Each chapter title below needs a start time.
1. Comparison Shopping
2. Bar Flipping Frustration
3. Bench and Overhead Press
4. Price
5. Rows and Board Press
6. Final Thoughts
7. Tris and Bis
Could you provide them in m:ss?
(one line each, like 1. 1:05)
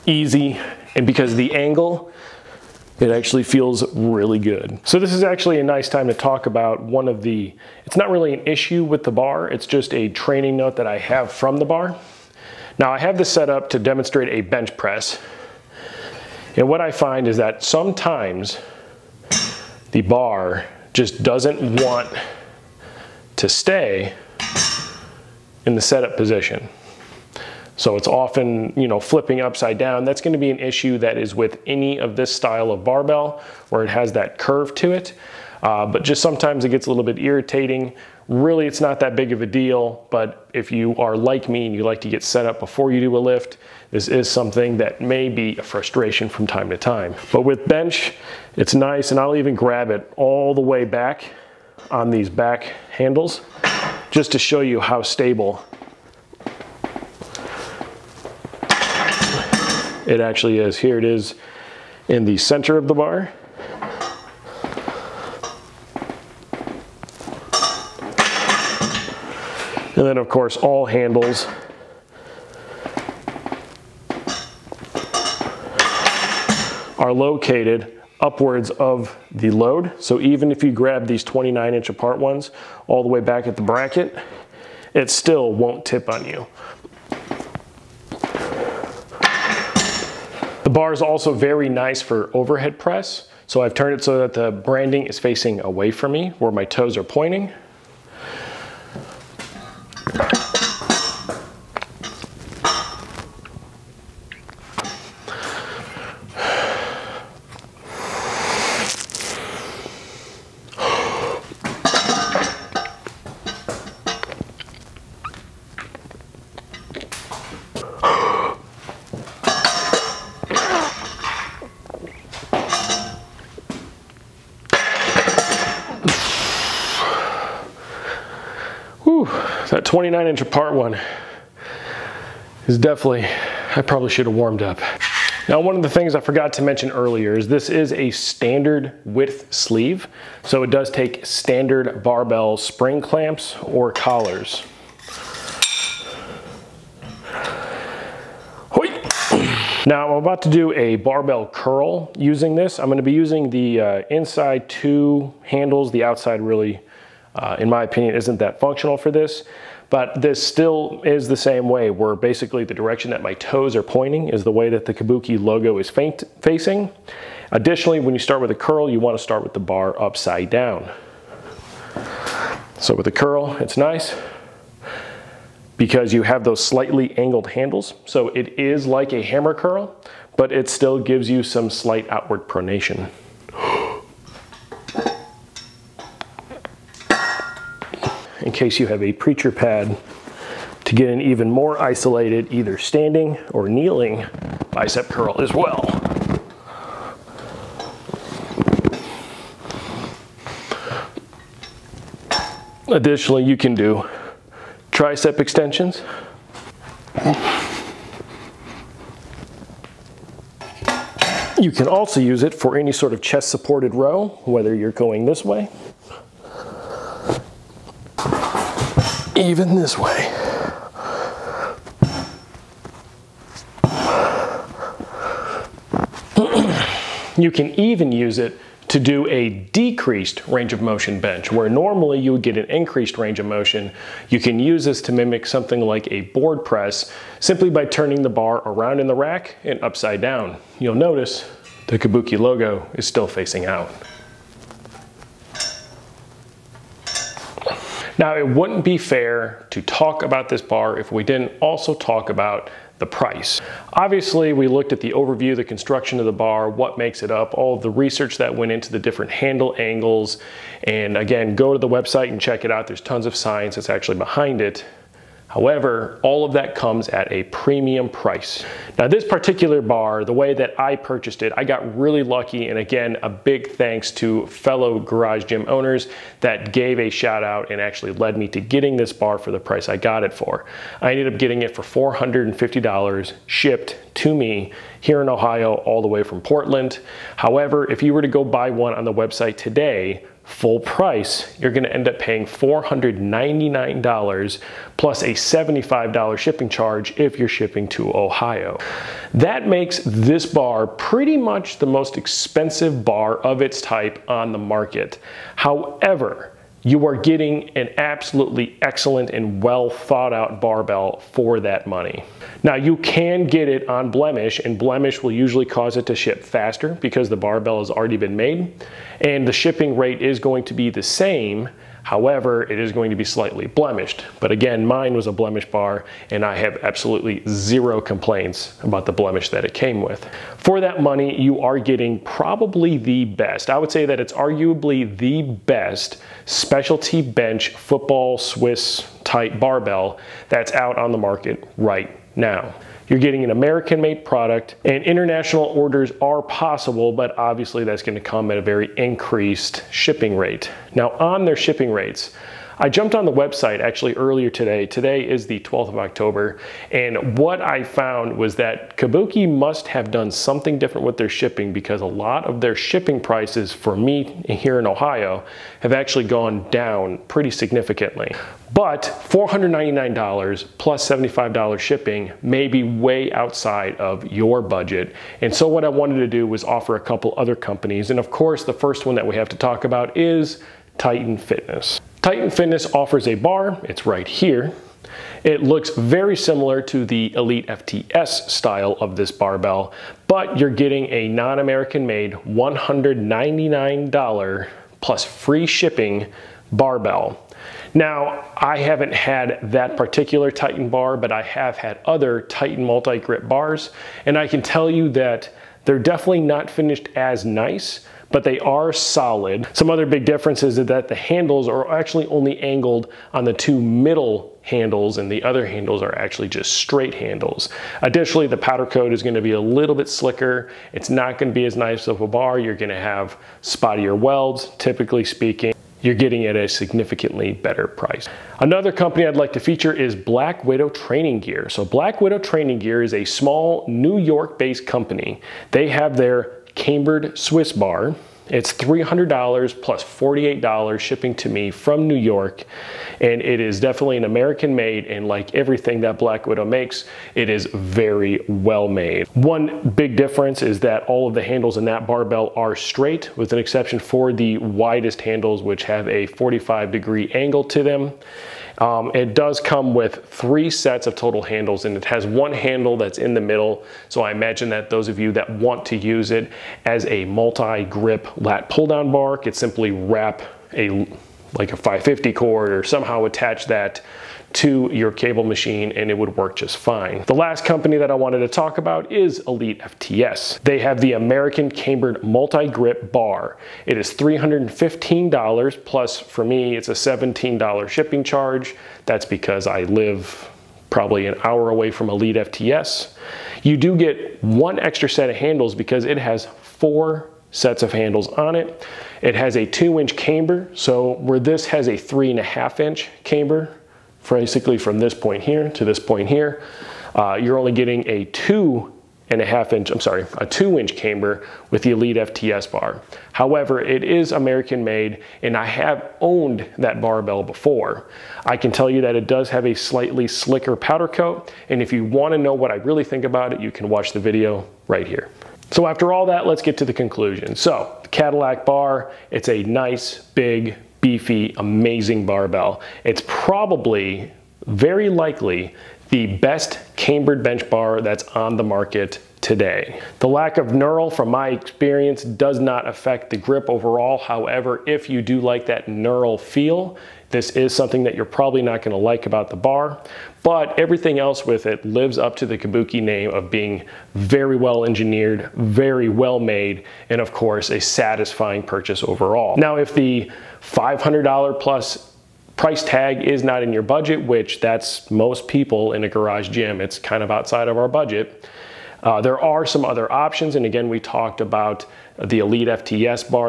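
1. 6:08
2. 0:05
3. 0:48
4. 4:08
5. 3:30
6. 8:45
7. 2:29.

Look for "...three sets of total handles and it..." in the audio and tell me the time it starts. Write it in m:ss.
7:40.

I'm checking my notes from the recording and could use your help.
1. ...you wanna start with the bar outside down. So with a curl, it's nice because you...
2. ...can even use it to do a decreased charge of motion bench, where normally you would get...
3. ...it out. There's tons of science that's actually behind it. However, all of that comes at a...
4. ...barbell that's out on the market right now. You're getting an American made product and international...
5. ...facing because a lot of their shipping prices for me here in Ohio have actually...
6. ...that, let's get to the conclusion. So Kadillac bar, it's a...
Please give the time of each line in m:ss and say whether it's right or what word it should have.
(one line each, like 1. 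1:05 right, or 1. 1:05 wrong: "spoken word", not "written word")
1. 2:48 wrong: "upside", not "outside"
2. 3:47 wrong: "range", not "charge"
3. 4:22 right
4. 5:39 right
5. 6:01 wrong: "shipping", not "facing"
6. 8:46 right.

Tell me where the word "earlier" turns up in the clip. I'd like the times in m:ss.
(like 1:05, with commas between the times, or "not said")
2:16, 5:54.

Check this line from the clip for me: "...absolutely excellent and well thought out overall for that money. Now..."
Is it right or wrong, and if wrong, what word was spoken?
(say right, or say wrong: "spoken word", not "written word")
wrong: "barbell", not "overall".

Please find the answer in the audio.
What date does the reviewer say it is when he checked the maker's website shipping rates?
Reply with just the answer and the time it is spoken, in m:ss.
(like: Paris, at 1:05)
12th of October, at 5:55.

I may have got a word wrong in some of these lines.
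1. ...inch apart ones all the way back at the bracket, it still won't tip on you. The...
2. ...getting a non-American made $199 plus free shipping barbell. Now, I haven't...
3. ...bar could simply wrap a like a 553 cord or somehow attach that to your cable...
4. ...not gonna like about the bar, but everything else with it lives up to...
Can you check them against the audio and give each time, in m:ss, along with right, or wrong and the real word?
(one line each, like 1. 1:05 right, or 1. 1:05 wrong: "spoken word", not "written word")
1. 1:21 right
2. 6:30 right
3. 7:49 wrong: "550", not "553"
4. 9:08 right.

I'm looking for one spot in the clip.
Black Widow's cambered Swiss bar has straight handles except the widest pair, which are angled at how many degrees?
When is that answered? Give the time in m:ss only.
7:36.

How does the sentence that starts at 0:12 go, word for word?
Now I have this set up to demonstrate a bench press.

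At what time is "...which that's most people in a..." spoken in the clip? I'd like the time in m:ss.
9:24.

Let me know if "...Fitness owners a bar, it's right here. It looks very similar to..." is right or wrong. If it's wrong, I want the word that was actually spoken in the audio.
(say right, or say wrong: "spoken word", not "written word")
wrong: "offers", not "owners".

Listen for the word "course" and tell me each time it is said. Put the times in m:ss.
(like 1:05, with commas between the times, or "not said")
1:10, 6:18, 9:17.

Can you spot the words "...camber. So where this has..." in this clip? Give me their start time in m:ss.
8:20.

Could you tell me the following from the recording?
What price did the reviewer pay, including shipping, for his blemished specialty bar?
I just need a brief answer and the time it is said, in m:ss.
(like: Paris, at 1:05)
$450, at 4:42.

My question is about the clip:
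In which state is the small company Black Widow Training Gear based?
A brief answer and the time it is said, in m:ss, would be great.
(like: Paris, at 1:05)
New York, at 7:22.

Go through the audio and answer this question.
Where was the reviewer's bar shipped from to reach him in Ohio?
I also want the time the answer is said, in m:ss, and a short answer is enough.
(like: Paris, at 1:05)
Portland, at 4:46.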